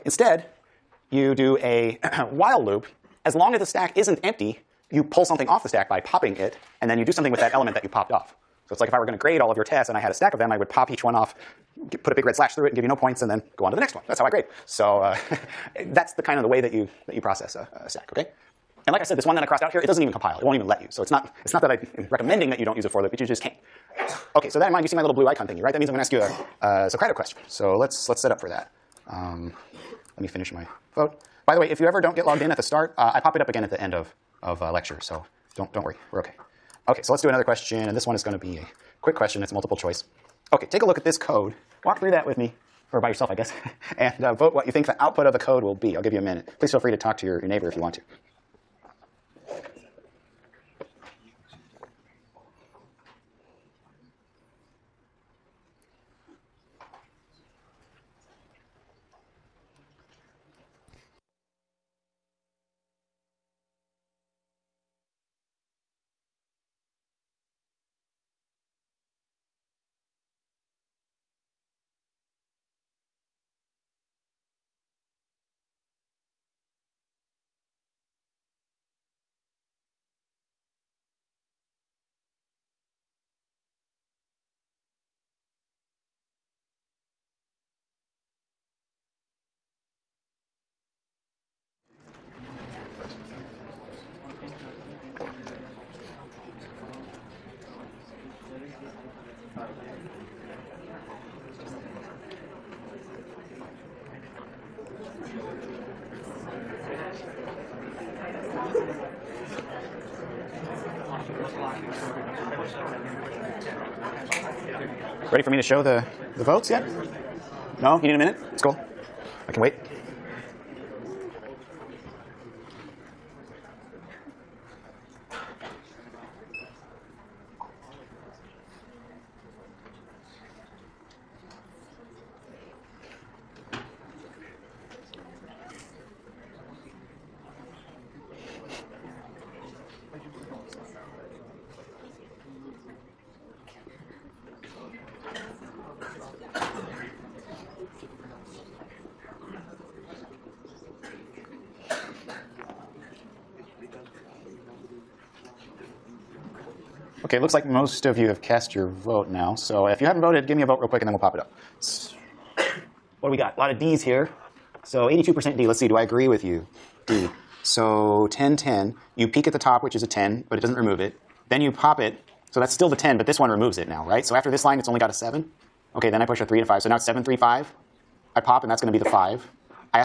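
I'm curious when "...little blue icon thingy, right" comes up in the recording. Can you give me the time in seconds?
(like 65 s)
25 s.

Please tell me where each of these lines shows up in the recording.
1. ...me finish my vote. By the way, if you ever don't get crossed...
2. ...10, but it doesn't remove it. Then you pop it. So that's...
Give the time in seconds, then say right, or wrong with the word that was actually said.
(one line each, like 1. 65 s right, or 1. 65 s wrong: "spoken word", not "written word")
1. 30 s wrong: "logged", not "crossed"
2. 170 s right.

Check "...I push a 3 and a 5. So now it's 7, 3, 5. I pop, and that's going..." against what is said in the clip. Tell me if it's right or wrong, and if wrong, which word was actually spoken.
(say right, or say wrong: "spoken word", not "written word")
right.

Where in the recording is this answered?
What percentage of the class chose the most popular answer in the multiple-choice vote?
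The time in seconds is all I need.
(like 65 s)
165 s.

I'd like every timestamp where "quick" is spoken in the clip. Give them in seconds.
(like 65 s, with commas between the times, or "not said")
39 s, 160 s.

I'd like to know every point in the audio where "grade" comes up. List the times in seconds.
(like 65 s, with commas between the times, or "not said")
9 s, 14 s.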